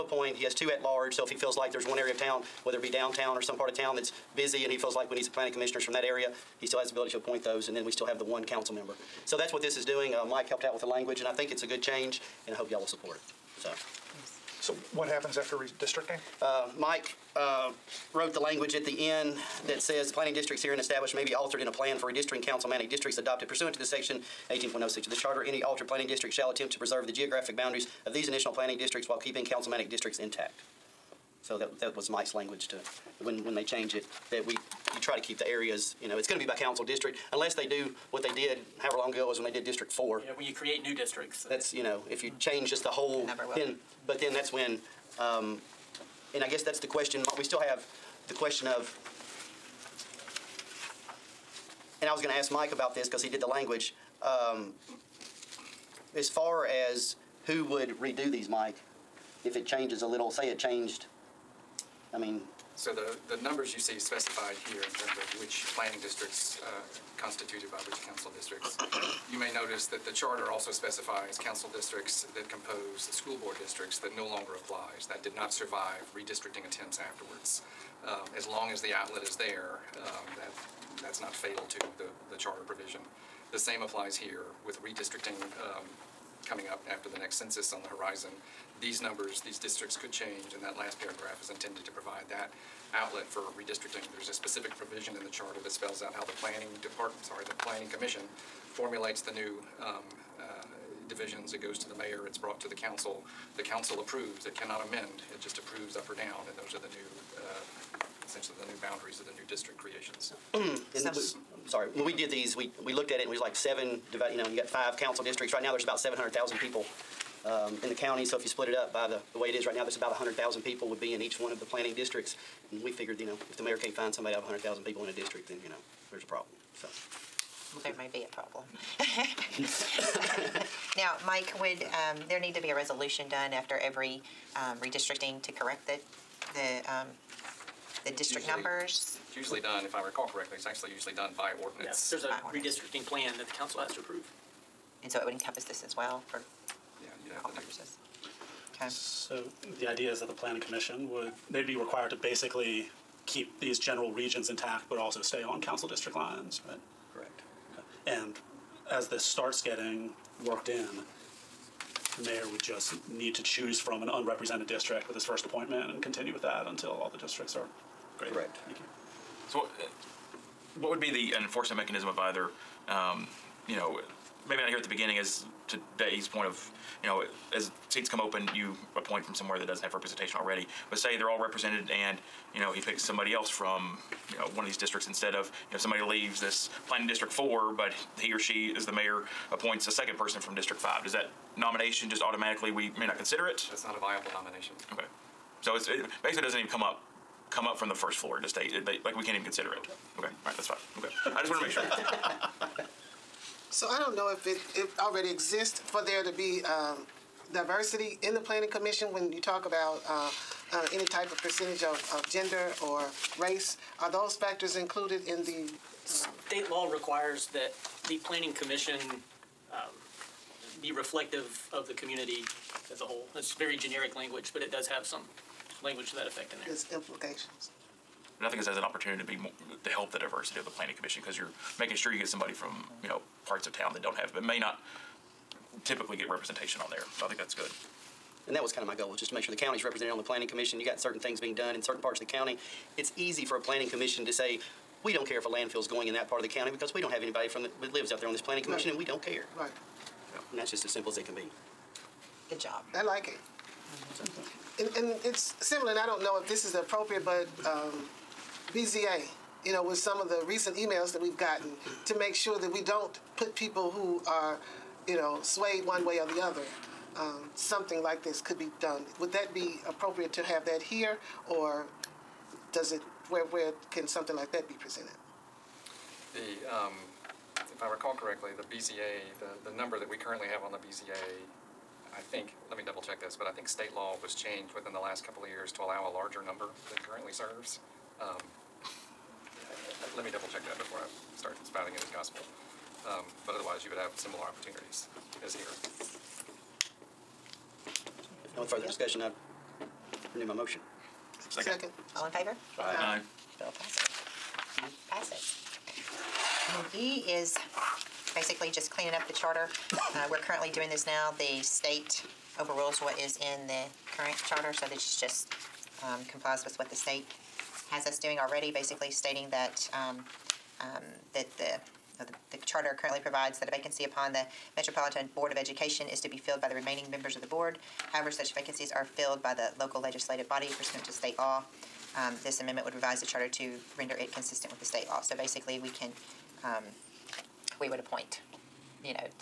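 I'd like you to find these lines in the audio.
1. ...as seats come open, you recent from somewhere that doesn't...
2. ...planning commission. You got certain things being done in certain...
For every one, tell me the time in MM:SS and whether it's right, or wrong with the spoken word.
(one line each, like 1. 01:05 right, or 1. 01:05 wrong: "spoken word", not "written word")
1. 02:57 wrong: "appoint", not "recent"
2. 04:00 right.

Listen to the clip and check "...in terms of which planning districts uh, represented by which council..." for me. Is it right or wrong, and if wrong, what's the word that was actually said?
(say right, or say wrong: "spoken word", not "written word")
wrong: "constituted", not "represented".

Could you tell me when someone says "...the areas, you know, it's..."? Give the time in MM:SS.
00:35.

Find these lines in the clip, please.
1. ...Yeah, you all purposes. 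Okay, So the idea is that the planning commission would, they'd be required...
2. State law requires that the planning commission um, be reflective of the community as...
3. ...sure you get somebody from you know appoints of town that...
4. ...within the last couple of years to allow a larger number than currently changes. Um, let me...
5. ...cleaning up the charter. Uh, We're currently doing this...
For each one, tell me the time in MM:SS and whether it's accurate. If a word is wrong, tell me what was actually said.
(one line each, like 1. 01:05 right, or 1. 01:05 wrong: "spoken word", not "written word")
1. 02:27 right
2. 03:36 right
3. 03:51 wrong: "parts", not "appoints"
4. 04:44 wrong: "serves", not "changes"
5. 05:08 right.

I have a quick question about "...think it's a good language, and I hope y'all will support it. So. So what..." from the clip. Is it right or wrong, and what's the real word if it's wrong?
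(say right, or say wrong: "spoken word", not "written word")
wrong: "change", not "language".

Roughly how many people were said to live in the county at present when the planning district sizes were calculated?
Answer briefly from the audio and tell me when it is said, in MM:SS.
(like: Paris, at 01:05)
700,000, at 01:55.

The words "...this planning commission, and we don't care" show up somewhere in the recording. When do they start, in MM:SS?
04:08.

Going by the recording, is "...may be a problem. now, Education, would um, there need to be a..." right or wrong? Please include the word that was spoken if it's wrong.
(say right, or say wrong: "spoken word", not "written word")
wrong: "Mike", not "Education".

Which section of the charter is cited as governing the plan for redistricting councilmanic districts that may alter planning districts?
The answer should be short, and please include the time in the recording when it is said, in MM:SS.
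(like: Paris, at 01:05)
18.06, at 00:24.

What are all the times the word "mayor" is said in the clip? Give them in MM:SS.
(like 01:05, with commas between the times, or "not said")
01:41, 02:03, 02:42, 03:08.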